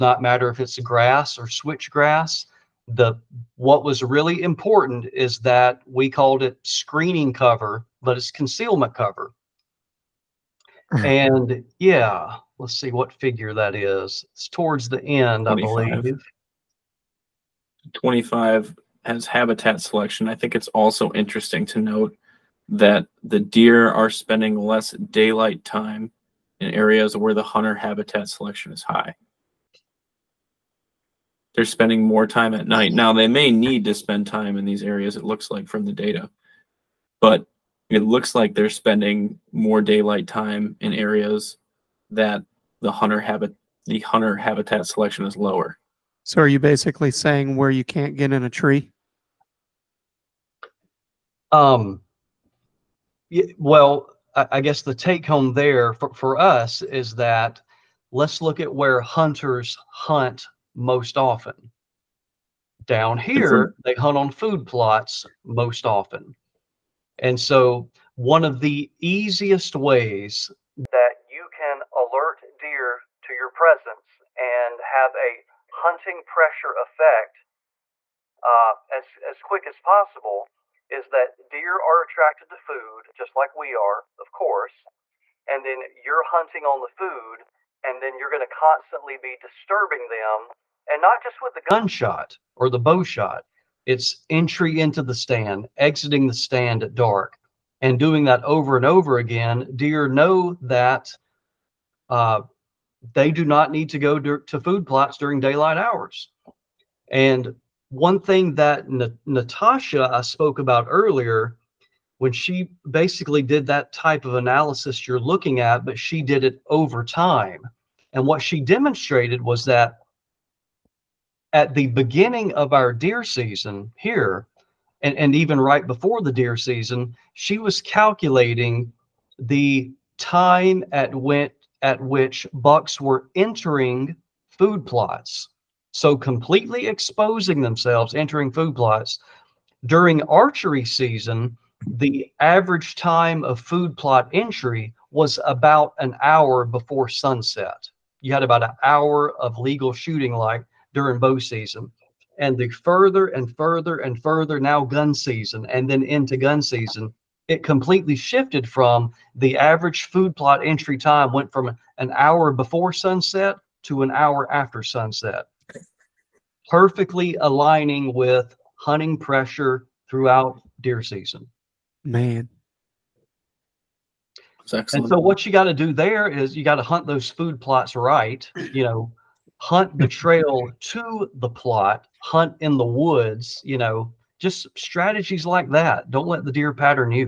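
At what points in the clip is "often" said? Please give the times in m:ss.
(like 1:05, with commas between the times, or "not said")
1:01, 1:05.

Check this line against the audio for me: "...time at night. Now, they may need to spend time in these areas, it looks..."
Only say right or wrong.
right.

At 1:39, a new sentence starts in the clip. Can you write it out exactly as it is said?
Deer know that uh, they do not need to go to food plots during daylight hours.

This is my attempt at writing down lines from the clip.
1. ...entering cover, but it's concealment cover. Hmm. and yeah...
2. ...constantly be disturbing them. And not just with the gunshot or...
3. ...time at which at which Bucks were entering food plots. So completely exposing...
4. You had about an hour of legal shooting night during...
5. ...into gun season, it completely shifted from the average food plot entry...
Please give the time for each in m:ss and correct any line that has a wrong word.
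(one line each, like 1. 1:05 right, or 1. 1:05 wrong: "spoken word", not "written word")
1. 0:06 wrong: "screening", not "entering"
2. 1:28 right
3. 2:10 right
4. 2:28 wrong: "light", not "night"
5. 2:36 right.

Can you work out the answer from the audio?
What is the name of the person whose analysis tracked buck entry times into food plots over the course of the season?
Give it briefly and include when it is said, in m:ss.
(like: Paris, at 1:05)
Natasha, at 1:49.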